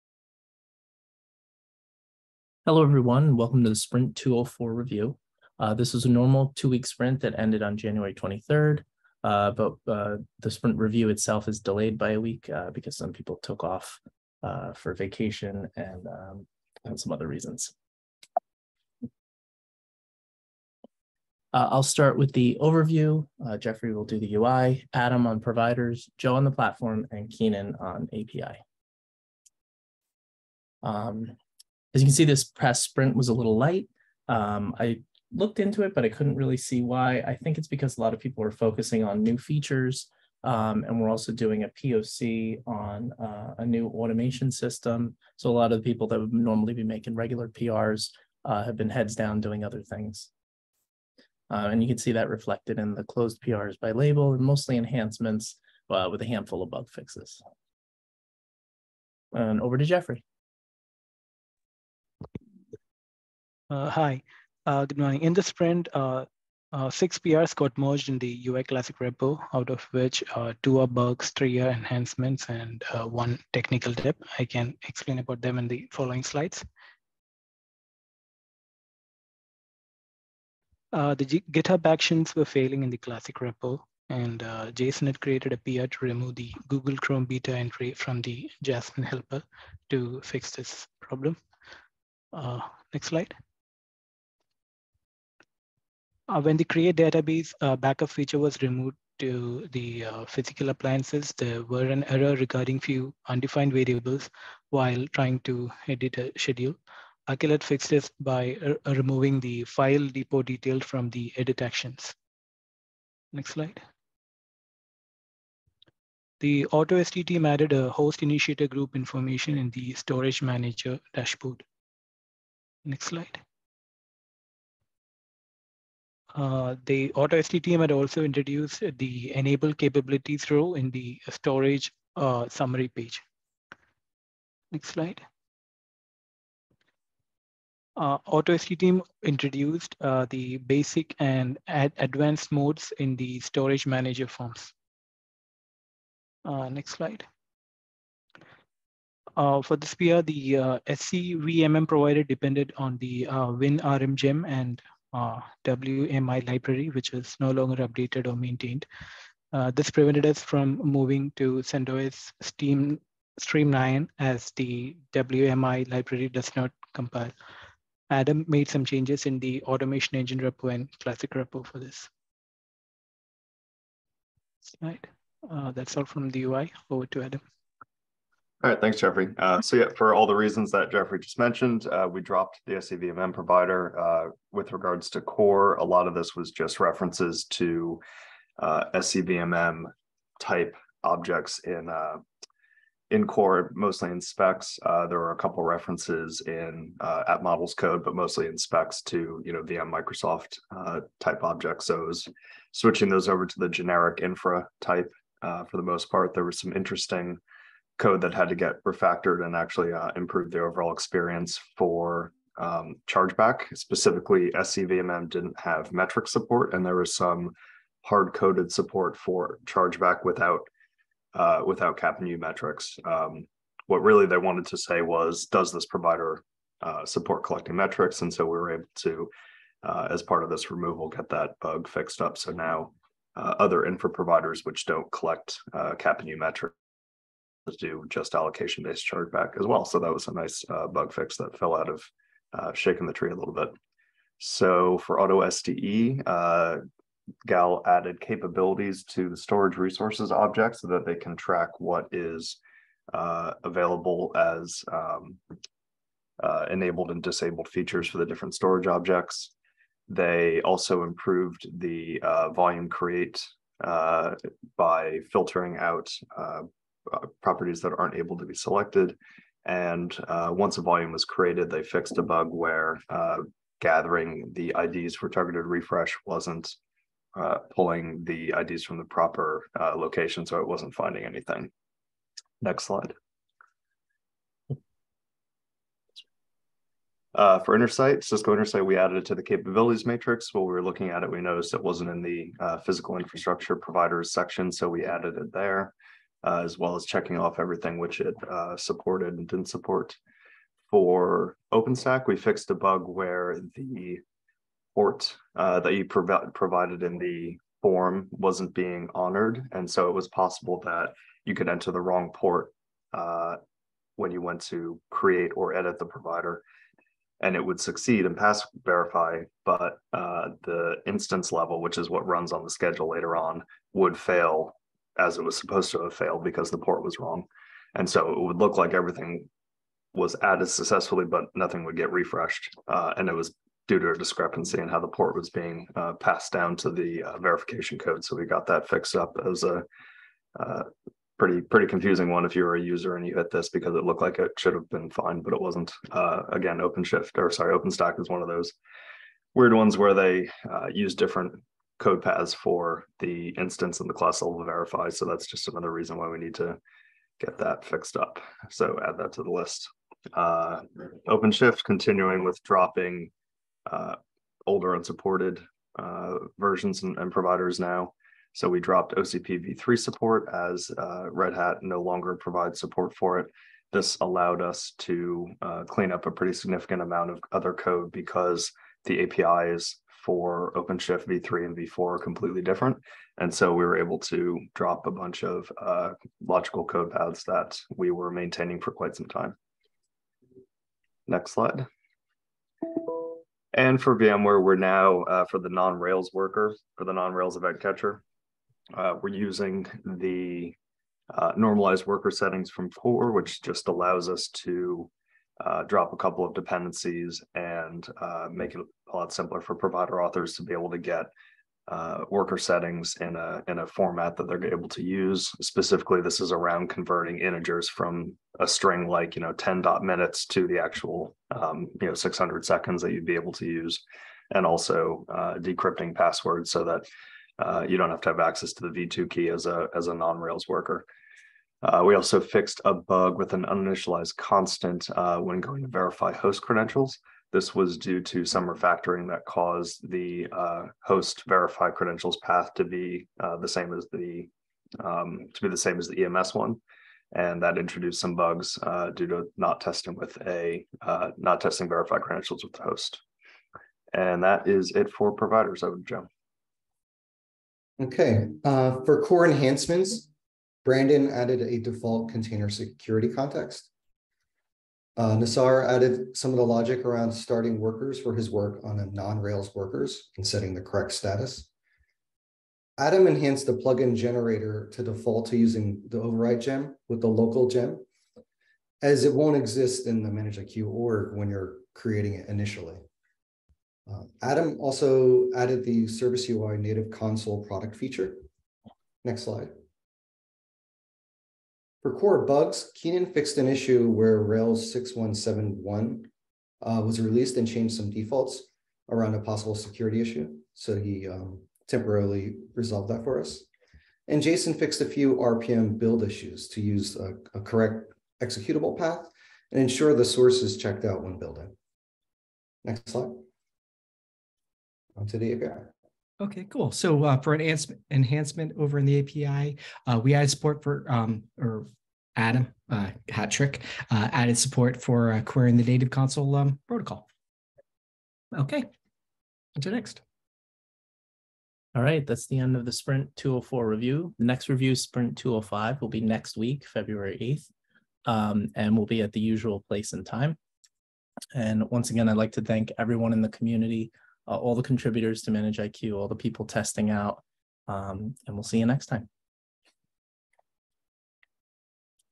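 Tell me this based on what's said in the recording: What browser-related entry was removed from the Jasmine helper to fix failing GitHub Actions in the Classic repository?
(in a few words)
Google Chrome beta.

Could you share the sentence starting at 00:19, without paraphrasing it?
Uh, I'll start with the overview.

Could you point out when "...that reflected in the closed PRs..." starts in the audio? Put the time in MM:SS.
00:52.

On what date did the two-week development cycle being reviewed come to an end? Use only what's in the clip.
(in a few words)
January 23.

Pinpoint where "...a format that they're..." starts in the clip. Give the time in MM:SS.
06:53.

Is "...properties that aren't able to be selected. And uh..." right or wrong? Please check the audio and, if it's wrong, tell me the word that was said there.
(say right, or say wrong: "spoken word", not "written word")
right.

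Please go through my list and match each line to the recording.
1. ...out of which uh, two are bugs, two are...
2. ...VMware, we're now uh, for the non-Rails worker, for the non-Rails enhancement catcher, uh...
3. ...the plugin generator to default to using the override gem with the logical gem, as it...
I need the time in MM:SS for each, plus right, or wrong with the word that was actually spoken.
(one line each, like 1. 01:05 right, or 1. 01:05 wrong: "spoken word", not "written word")
1. 01:09 wrong: "three", not "two"
2. 06:34 wrong: "event", not "enhancement"
3. 07:53 wrong: "local", not "logical".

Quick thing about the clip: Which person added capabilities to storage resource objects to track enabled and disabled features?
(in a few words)
Gal.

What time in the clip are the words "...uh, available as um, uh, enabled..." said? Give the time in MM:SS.
04:13.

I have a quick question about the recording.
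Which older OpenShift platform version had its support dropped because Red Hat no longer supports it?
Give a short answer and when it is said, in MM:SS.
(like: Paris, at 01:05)
OCP v3, at 06:09.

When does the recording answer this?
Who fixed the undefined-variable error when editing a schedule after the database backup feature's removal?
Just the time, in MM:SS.
01:47.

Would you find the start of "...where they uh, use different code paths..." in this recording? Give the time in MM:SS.
05:49.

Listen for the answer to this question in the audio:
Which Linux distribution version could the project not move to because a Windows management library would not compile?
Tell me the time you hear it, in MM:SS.
02:41.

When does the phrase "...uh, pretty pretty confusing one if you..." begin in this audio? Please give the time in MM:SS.
05:40.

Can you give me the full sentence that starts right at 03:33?
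Specifically, SCVMM didn't have metric support, and there was some hard coded support for chargeback without uh, without new metrics.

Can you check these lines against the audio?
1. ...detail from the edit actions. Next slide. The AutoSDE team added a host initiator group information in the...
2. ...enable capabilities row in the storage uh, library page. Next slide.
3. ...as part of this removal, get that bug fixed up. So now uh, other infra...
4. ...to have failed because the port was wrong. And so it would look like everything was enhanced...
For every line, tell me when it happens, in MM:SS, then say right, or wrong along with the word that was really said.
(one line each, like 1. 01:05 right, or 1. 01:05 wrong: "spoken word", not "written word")
1. 01:50 right
2. 02:09 wrong: "summary", not "library"
3. 03:50 right
4. 05:25 wrong: "added", not "enhanced".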